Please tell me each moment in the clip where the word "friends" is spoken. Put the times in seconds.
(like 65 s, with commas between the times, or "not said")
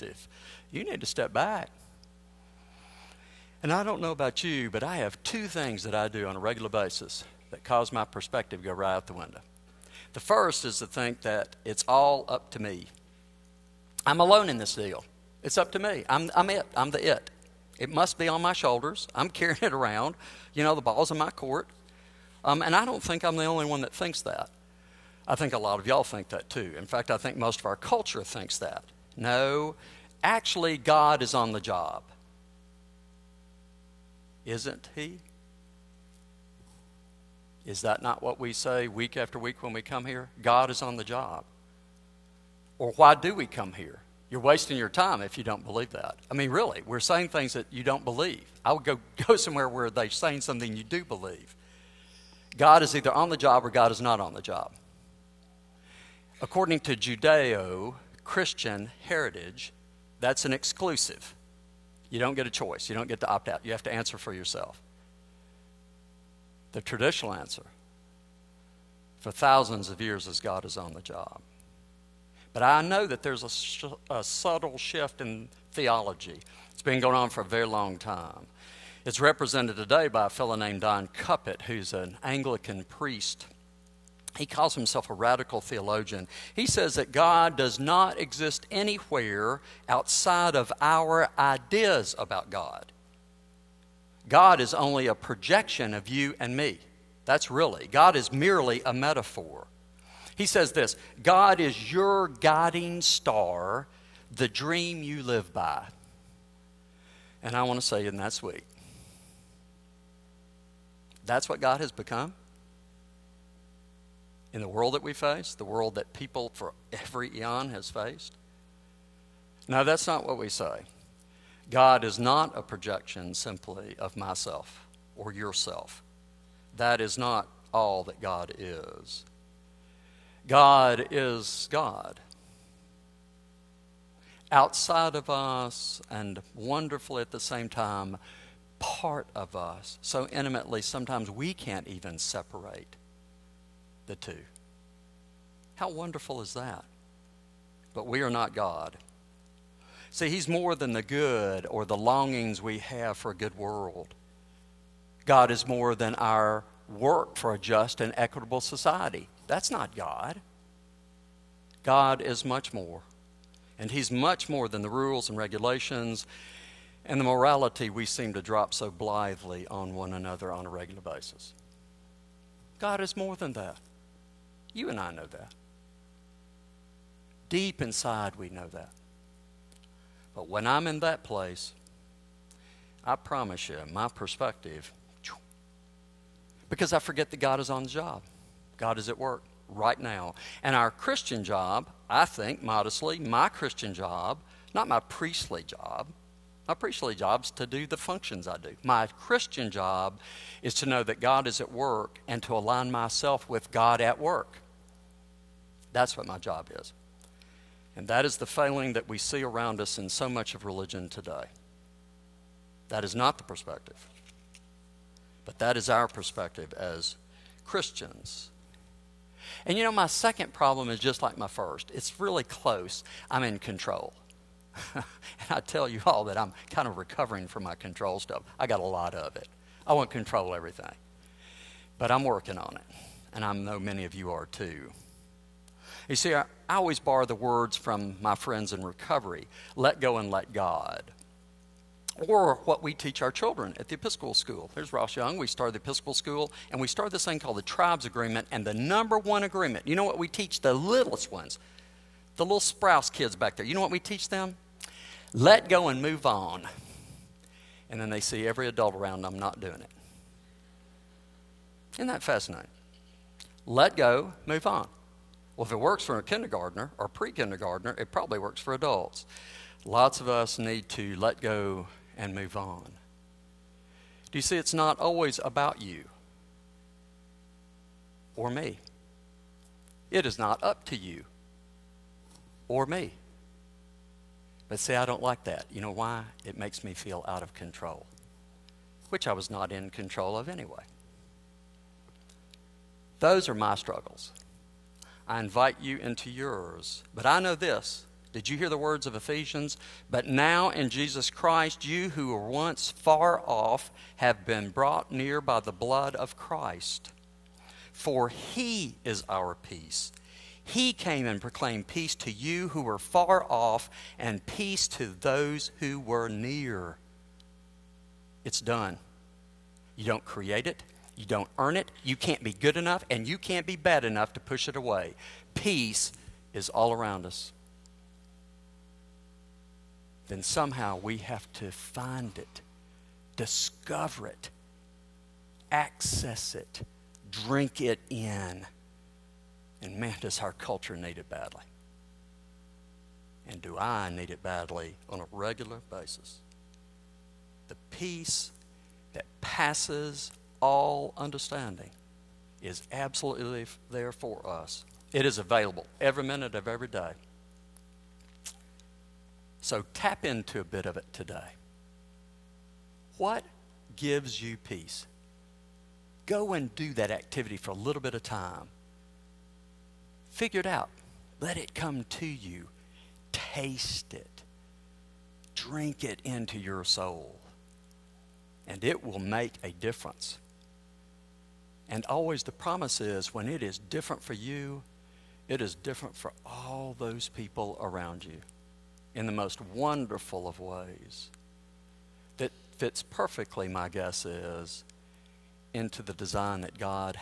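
238 s.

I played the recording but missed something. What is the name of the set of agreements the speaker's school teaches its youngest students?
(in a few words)
Tribes Agreement.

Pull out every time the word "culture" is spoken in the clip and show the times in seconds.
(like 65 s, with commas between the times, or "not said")
27 s, 340 s.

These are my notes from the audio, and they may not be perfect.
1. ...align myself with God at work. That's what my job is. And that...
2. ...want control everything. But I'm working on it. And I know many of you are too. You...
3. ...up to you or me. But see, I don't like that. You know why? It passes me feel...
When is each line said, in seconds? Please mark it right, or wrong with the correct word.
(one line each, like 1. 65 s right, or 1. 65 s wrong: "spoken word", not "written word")
1. 202 s right
2. 229 s right
3. 280 s wrong: "makes", not "passes".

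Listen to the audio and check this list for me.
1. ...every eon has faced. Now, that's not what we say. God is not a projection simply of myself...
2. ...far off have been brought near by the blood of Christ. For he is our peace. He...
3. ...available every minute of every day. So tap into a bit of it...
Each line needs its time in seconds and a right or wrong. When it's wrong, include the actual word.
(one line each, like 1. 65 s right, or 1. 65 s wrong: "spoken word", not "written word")
1. 116 s right
2. 302 s right
3. 355 s right.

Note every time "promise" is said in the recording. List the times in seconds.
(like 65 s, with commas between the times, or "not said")
183 s, 382 s.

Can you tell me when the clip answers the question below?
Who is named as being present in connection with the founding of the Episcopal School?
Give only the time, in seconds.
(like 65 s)
244 s.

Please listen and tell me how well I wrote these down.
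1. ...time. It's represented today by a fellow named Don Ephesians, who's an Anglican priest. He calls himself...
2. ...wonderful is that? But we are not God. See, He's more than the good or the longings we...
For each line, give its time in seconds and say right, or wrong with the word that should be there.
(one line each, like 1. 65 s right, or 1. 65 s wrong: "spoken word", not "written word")
1. 77 s wrong: "Cupitt", not "Ephesians"
2. 145 s right.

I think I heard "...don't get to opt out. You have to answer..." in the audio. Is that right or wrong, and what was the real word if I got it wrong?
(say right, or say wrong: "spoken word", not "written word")
right.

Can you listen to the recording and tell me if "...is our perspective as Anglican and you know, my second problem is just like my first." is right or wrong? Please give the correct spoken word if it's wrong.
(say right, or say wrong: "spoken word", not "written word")
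wrong: "Christians", not "Anglican".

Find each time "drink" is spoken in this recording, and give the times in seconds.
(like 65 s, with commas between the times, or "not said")
337 s, 375 s.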